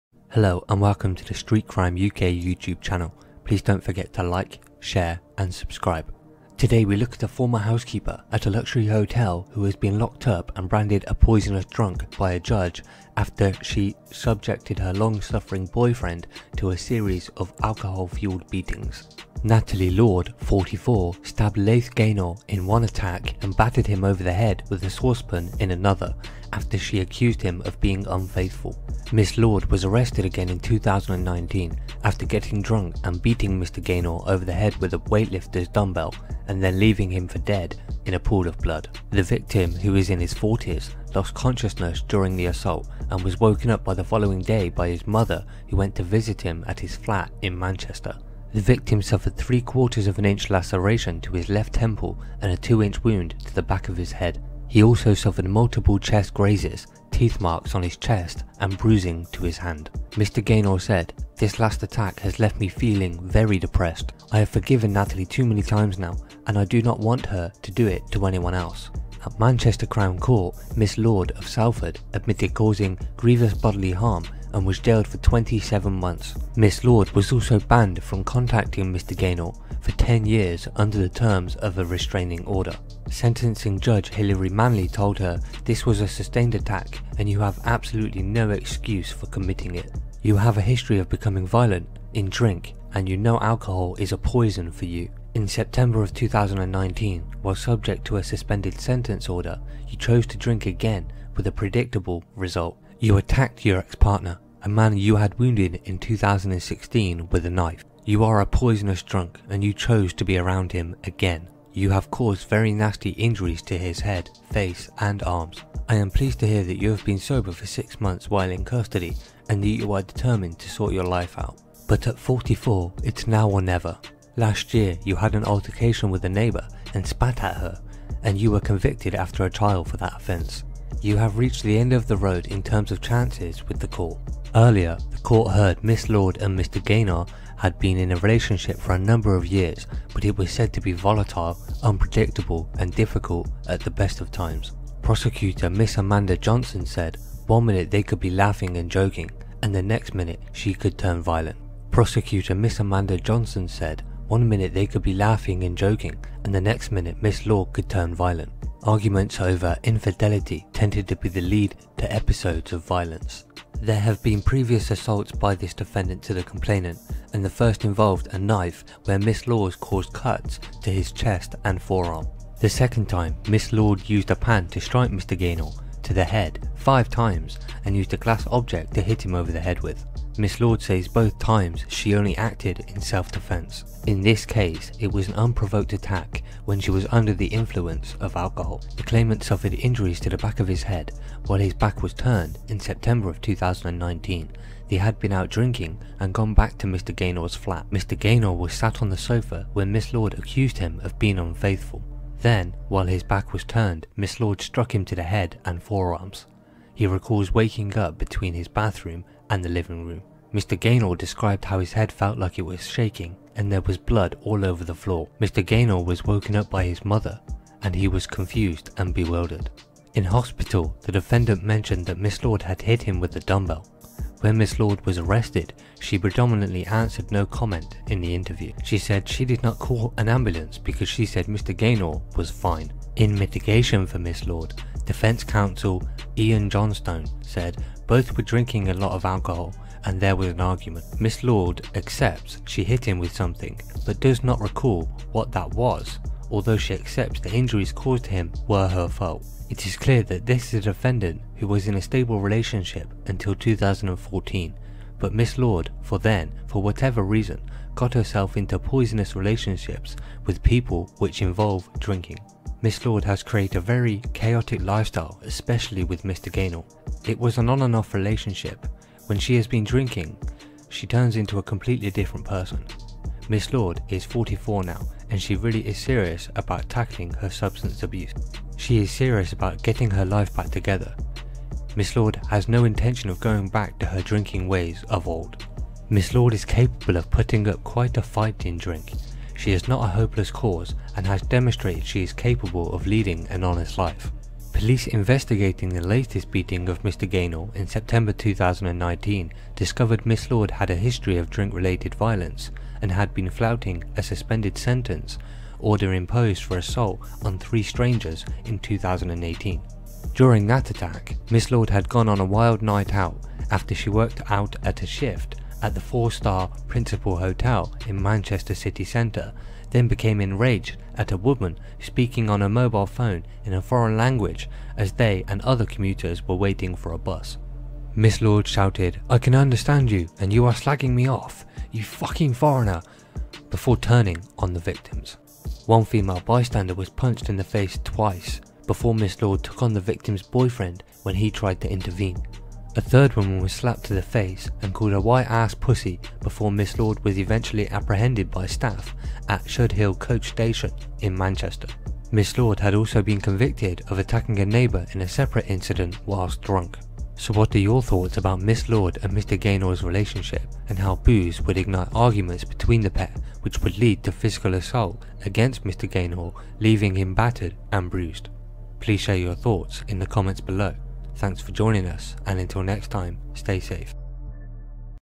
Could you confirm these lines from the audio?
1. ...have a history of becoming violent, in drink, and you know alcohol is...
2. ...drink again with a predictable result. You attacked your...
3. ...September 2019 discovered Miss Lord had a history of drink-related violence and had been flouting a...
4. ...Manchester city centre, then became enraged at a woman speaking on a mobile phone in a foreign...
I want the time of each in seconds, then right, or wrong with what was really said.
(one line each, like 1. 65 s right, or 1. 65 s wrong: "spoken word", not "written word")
1. 90 s right
2. 100 s right
3. 297 s right
4. 318 s right.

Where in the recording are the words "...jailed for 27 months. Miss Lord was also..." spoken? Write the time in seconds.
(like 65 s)
74 s.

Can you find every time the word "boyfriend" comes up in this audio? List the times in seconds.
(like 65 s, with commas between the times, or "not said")
15 s, 340 s.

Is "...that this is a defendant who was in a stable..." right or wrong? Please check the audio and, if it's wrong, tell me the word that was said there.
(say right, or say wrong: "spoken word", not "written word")
right.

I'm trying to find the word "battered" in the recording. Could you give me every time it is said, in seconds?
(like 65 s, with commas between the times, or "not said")
23 s, 367 s.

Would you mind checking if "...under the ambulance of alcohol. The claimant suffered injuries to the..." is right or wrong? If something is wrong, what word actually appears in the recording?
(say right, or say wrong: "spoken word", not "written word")
wrong: "influence", not "ambulance".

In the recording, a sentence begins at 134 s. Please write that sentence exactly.
Earlier, the court heard Miss Lord and Mr.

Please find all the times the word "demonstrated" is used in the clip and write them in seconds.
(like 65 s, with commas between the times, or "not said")
291 s.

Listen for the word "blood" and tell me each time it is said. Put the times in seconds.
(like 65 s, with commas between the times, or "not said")
38 s, 213 s.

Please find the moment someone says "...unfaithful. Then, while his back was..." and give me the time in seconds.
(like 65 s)
201 s.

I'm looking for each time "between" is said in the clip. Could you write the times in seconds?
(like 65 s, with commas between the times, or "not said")
208 s, 362 s.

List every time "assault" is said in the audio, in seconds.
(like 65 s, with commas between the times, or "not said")
42 s, 164 s, 306 s, 364 s.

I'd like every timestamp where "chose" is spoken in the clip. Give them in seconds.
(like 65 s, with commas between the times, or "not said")
99 s, 109 s.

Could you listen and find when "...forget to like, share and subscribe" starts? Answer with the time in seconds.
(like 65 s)
3 s.